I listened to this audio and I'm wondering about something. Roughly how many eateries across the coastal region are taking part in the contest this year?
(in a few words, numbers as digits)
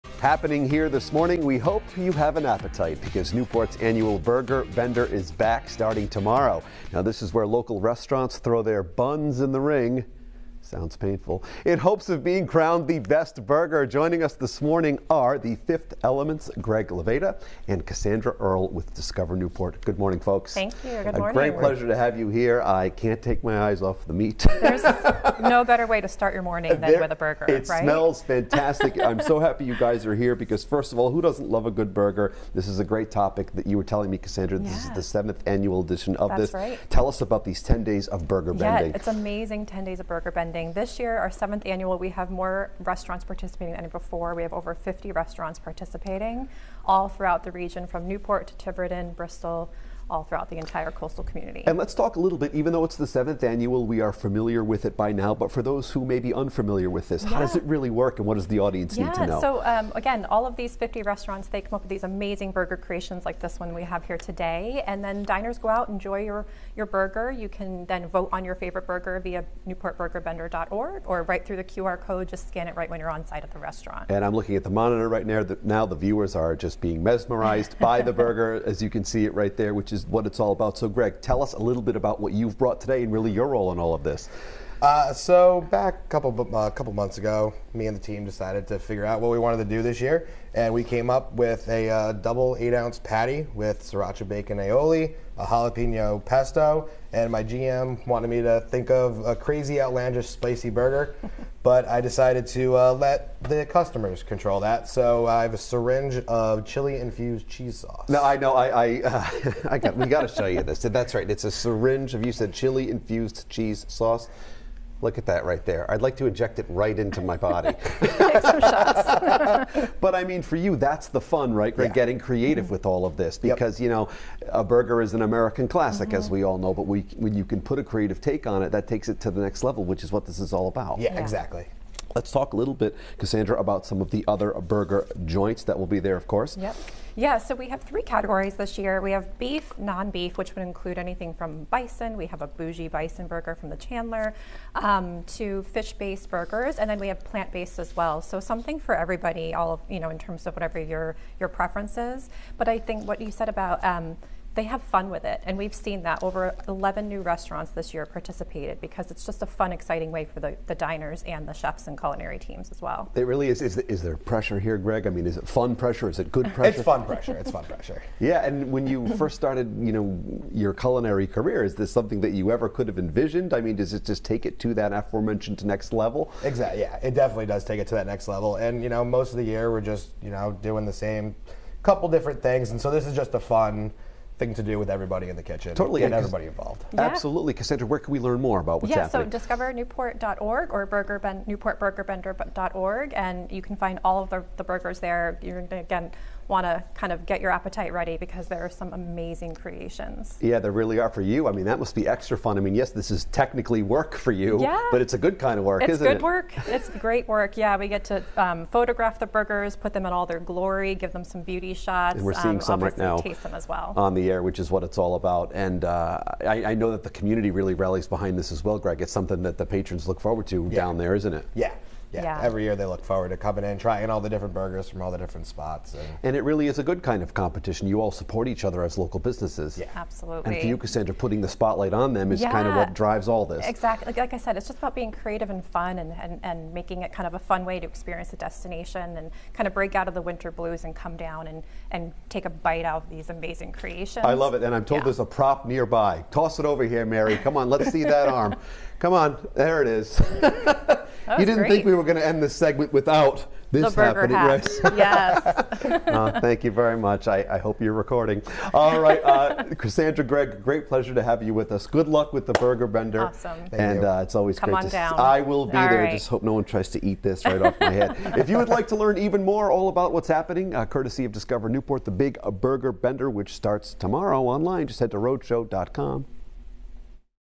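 over 50.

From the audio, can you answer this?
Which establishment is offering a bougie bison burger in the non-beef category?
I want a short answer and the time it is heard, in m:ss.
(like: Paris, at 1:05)
the Chanler, at 2:23.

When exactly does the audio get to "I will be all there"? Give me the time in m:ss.
4:25.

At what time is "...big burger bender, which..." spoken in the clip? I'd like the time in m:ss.
4:32.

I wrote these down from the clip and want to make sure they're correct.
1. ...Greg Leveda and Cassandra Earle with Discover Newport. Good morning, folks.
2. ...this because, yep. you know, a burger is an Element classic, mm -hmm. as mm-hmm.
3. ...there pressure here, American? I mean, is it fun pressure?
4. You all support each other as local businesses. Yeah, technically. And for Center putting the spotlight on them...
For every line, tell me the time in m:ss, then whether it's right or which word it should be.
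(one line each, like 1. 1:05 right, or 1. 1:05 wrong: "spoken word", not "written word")
1. 0:16 right
2. 2:03 wrong: "American", not "Element"
3. 2:44 wrong: "Greg", not "American"
4. 3:47 wrong: "absolutely", not "technically".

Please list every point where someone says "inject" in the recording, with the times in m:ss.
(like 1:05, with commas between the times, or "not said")
1:56.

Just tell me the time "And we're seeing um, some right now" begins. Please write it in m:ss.
3:32.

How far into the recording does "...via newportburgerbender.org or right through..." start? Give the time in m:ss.
1:09.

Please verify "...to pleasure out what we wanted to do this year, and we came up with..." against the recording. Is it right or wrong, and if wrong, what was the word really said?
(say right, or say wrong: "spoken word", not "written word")
wrong: "figure", not "pleasure".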